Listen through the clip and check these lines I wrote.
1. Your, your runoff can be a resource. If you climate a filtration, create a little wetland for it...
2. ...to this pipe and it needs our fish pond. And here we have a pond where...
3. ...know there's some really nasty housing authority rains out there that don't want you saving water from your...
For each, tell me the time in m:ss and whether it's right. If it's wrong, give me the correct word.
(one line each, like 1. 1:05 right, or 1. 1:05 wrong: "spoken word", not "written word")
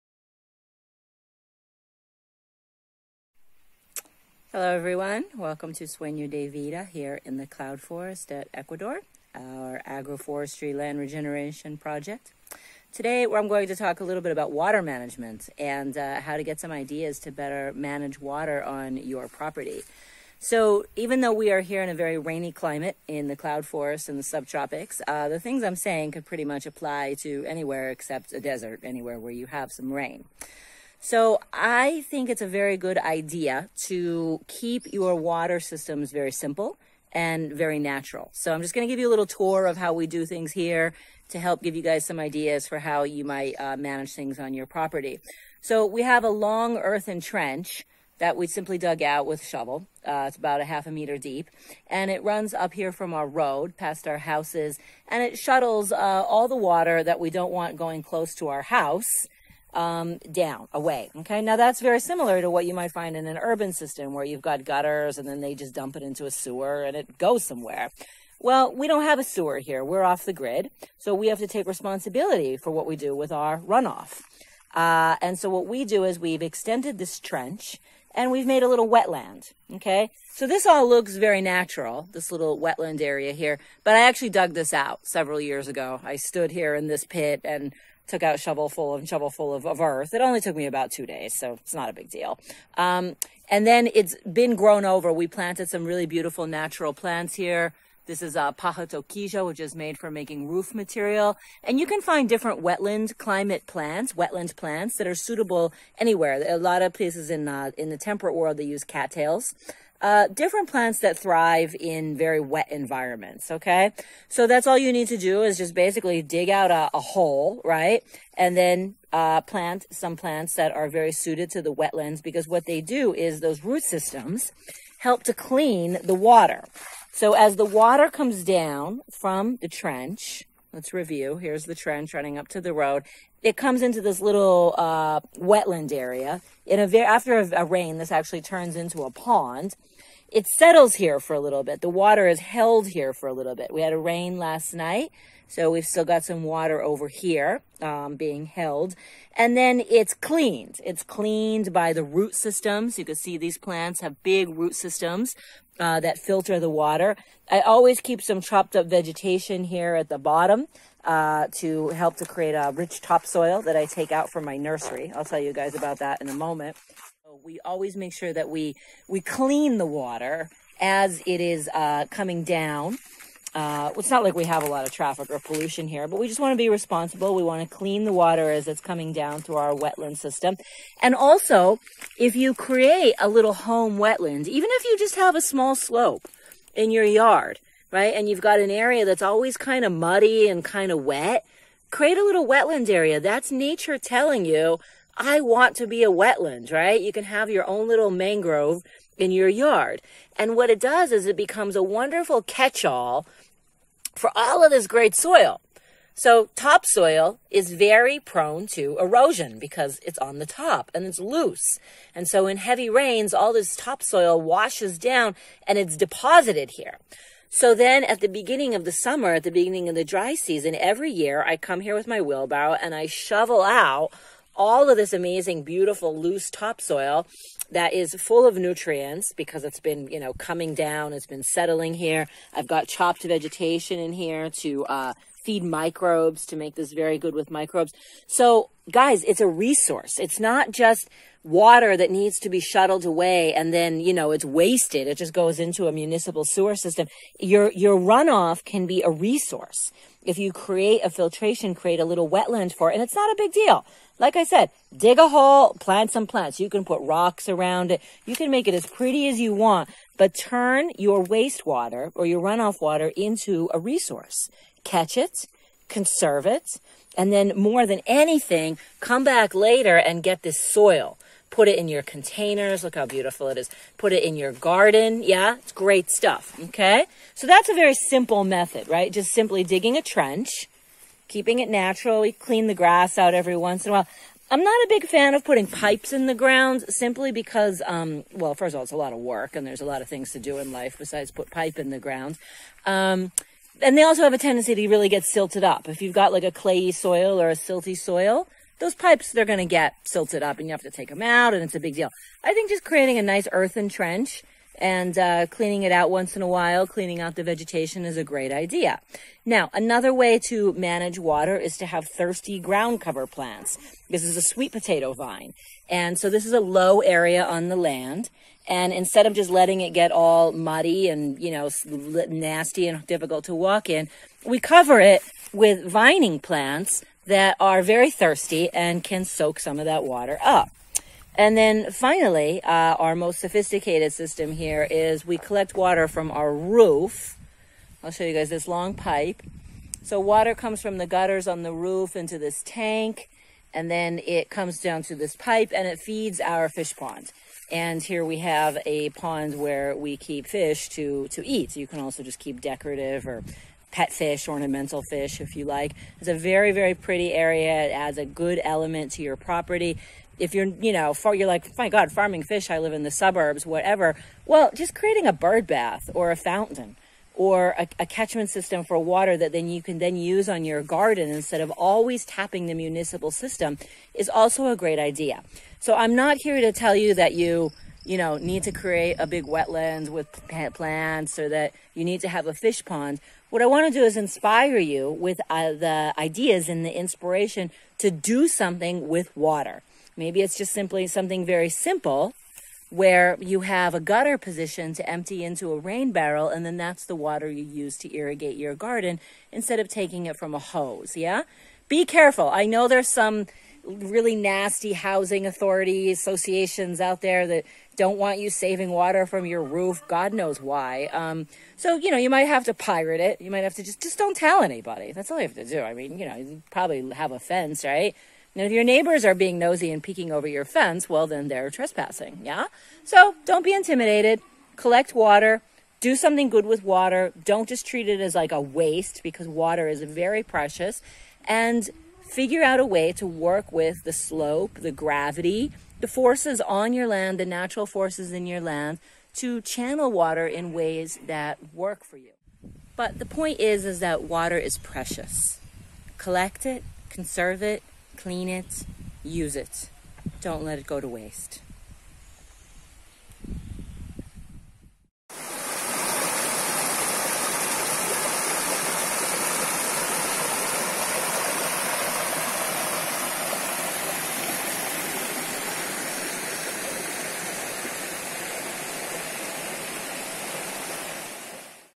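1. 4:07 wrong: "create", not "climate"
2. 5:45 wrong: "feeds", not "needs"
3. 6:42 wrong: "associations", not "rains".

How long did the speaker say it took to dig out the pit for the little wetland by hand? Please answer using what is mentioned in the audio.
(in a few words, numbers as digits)
2 days.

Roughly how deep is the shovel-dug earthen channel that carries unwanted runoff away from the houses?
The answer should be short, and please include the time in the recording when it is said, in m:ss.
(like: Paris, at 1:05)
half a meter, at 0:50.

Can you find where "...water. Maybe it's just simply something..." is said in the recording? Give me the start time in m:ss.
6:29.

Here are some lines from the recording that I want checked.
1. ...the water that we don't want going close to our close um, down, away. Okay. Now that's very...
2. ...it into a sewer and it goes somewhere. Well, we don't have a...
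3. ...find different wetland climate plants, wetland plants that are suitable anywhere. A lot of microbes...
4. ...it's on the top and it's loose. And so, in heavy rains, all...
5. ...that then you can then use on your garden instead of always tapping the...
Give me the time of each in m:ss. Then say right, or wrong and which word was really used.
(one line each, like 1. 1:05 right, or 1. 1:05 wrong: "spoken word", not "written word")
1. 0:56 wrong: "house", not "close"
2. 1:05 right
3. 1:42 wrong: "places", not "microbes"
4. 3:30 right
5. 6:09 right.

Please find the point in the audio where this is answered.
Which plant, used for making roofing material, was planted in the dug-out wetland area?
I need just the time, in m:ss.
1:38.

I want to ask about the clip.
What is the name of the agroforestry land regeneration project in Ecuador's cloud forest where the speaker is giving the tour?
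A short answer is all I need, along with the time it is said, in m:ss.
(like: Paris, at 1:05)
Sueño de Vida, at 0:05.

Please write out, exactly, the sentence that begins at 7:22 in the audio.
But the point is, is that water is precious.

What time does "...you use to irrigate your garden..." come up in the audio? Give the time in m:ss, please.
6:37.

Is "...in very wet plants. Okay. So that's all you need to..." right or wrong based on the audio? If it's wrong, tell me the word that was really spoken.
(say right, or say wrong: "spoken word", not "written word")
wrong: "environments", not "plants".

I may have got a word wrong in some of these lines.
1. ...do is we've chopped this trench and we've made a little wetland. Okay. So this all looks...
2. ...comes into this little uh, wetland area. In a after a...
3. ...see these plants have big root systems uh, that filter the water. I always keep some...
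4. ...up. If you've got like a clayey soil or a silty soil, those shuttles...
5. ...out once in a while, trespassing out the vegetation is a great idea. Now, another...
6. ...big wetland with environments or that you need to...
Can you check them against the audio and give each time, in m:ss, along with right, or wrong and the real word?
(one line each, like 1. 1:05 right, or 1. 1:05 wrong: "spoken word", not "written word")
1. 1:15 wrong: "extended", not "chopped"
2. 2:13 right
3. 2:33 right
4. 4:55 wrong: "pipes", not "shuttles"
5. 5:05 wrong: "cleaning", not "trespassing"
6. 6:19 wrong: "plants", not "environments".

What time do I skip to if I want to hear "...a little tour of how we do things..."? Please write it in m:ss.
0:39.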